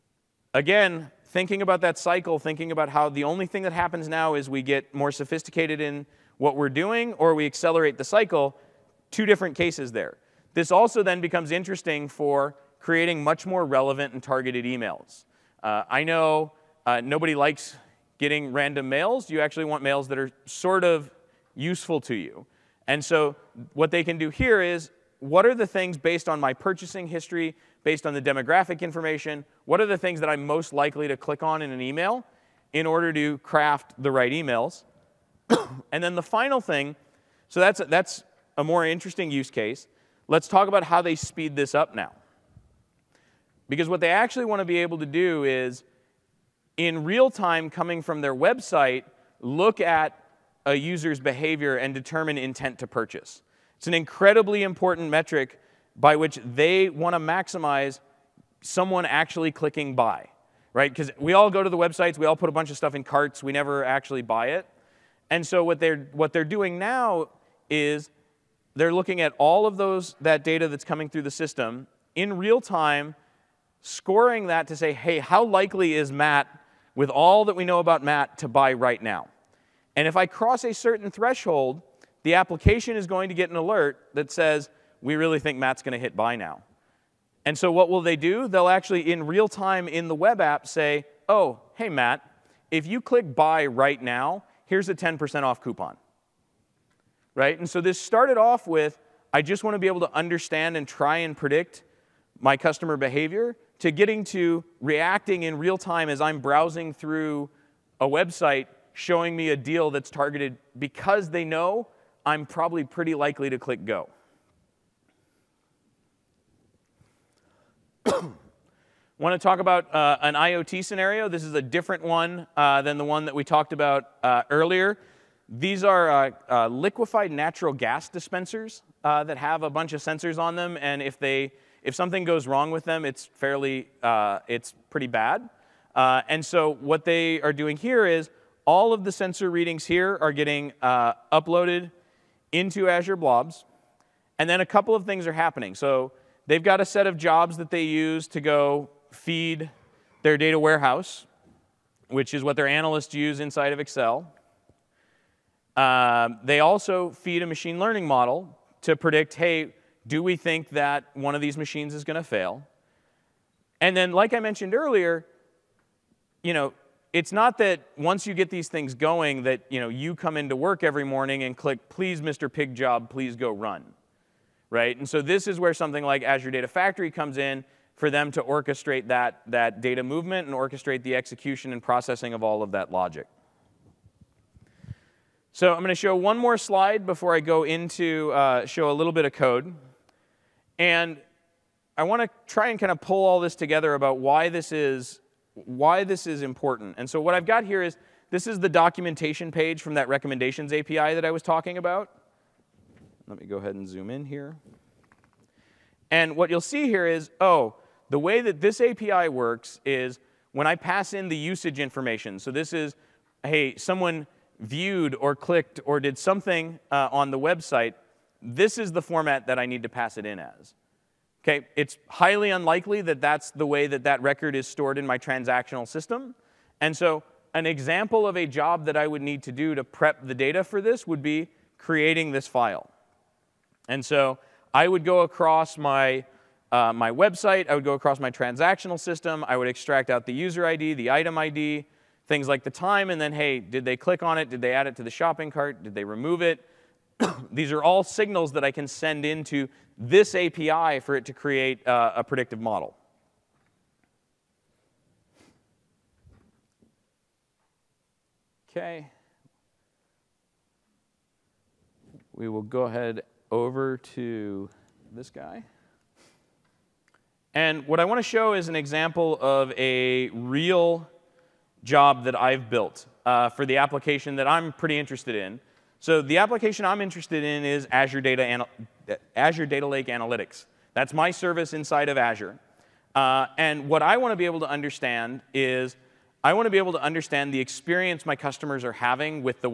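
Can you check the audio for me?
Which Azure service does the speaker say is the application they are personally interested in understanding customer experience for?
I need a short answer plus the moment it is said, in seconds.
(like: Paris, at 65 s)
Azure Data Lake Analytics, at 279 s.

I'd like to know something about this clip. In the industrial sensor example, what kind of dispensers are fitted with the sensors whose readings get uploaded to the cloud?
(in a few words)
liquefied natural gas.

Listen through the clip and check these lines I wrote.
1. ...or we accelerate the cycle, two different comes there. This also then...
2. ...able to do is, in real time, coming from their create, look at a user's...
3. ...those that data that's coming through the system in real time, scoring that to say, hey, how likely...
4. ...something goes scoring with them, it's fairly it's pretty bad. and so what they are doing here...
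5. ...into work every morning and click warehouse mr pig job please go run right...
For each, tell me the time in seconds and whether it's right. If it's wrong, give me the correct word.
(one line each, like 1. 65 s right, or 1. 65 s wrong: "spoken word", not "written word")
1. 7 s wrong: "cases", not "comes"
2. 44 s wrong: "website", not "create"
3. 69 s right
4. 131 s wrong: "wrong", not "scoring"
5. 170 s wrong: "please", not "warehouse".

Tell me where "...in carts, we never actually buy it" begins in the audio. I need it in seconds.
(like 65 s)
62 s.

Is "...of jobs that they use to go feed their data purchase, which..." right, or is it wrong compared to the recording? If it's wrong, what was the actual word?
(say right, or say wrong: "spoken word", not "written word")
wrong: "warehouse", not "purchase".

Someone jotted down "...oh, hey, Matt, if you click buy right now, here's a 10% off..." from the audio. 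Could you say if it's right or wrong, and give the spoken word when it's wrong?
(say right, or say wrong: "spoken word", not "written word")
right.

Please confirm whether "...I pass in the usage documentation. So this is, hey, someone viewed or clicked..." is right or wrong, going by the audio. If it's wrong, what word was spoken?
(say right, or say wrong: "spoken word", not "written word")
wrong: "information", not "documentation".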